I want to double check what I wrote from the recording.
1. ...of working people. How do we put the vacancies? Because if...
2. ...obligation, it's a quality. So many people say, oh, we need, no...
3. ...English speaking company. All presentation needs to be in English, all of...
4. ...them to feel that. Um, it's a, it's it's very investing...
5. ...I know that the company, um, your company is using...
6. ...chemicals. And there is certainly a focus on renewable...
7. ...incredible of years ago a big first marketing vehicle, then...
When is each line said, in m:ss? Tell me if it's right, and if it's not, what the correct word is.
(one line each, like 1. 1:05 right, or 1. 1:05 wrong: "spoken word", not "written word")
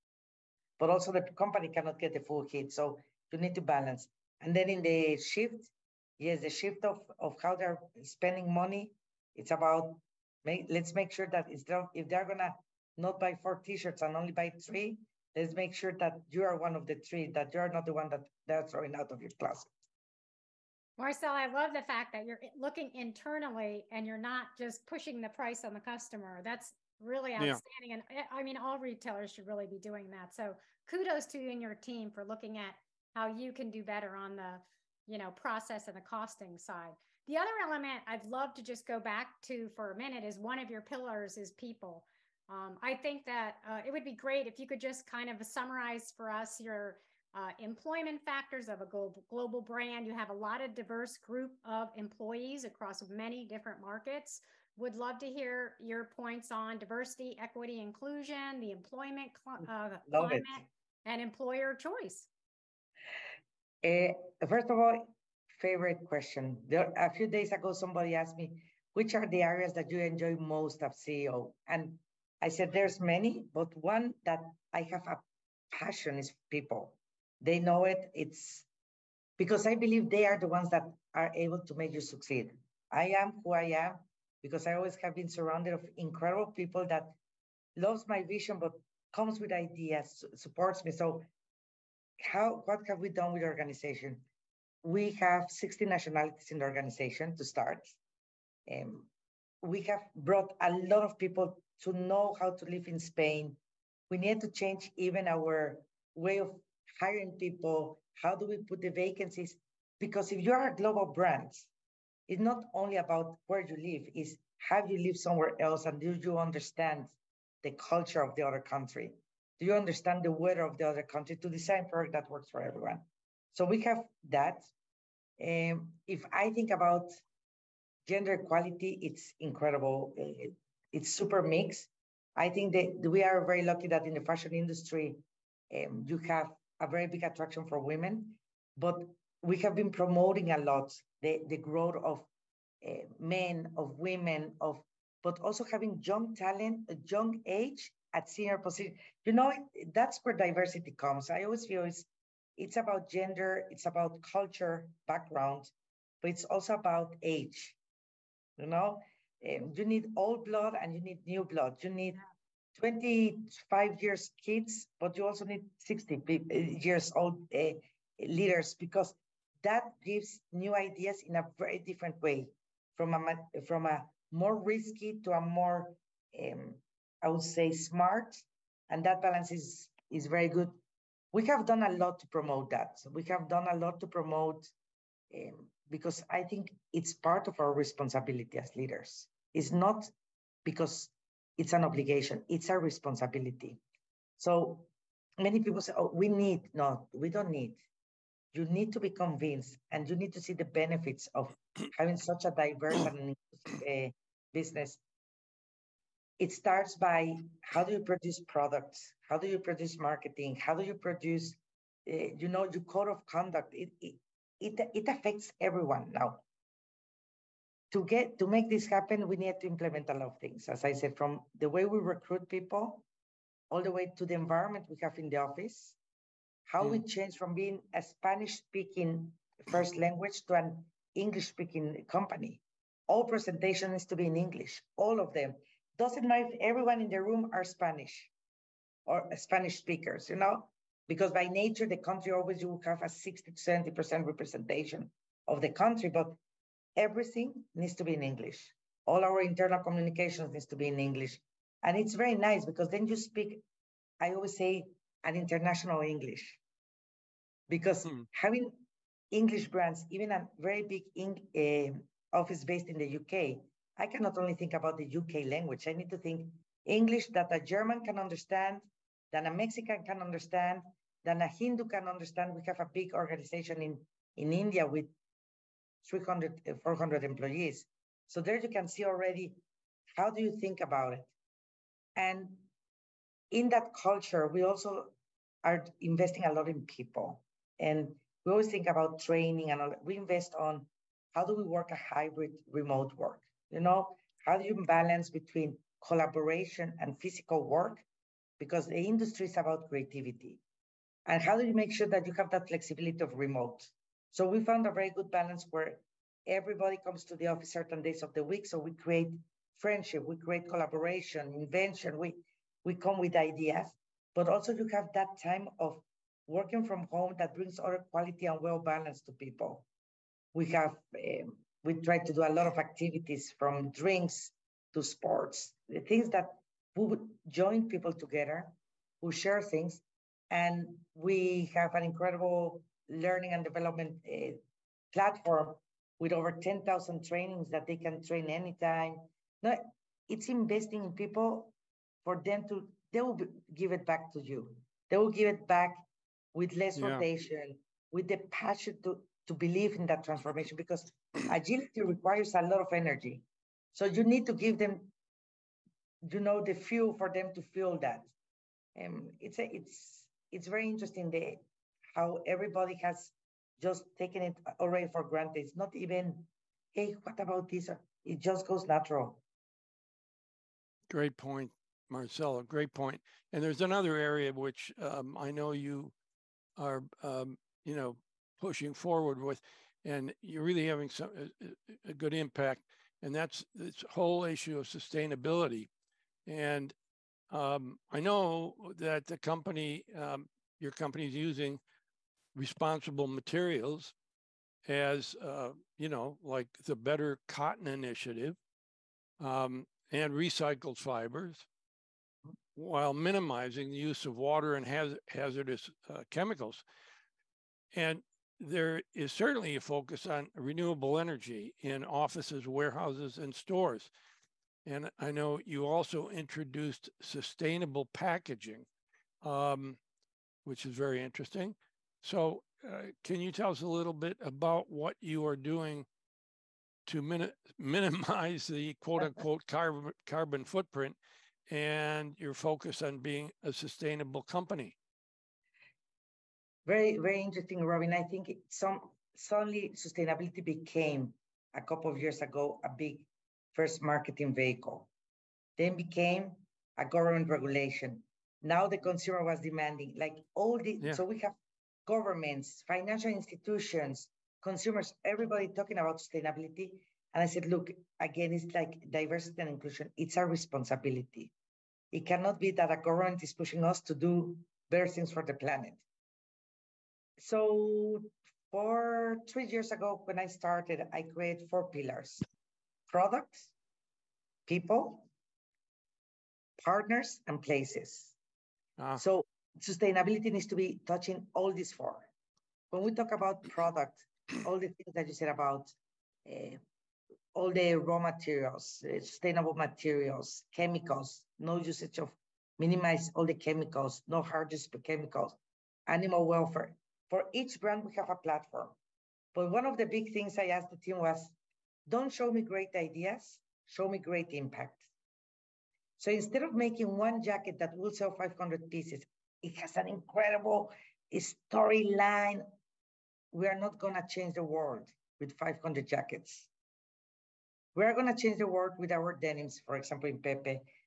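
1. 1:46 wrong: "hiring", not "working"
2. 3:11 wrong: "responsibility", not "quality"
3. 3:51 right
4. 5:57 wrong: "interesting", not "investing"
5. 6:28 right
6. 6:46 right
7. 7:21 wrong: "couple", not "incredible".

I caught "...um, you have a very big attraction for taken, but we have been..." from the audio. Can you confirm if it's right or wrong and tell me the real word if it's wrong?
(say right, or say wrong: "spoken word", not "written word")
wrong: "women", not "taken".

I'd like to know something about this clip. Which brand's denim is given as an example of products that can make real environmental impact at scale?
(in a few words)
Pepe.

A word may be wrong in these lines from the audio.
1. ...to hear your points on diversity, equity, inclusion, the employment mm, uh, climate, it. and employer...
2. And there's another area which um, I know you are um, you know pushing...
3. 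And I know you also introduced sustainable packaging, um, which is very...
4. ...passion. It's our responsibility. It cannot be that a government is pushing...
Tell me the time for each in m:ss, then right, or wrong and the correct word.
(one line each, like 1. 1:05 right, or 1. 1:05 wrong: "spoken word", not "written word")
1. 0:55 right
2. 6:13 right
3. 6:54 right
4. 7:39 wrong: "inclusion", not "passion".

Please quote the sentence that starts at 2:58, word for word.
And that balance is, is very good.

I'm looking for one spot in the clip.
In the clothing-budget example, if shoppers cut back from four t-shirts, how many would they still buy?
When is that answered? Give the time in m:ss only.
0:14.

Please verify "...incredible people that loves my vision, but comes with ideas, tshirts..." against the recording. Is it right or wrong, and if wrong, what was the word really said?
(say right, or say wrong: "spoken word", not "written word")
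wrong: "supports", not "tshirts".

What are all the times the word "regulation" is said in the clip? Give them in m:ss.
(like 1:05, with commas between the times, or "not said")
7:27.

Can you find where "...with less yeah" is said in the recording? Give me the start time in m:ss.
5:46.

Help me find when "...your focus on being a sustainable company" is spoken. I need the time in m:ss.
7:12.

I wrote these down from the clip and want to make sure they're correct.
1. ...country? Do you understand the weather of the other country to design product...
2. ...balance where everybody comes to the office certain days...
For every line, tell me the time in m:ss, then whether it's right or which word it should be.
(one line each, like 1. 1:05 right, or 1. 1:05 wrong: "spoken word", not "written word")
1. 1:58 right
2. 5:05 right.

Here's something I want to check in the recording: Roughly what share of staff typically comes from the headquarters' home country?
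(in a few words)
60 to 70%.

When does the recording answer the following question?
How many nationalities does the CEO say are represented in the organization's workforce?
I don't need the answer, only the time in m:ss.
1:35.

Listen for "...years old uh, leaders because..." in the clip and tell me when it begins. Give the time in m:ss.
2:46.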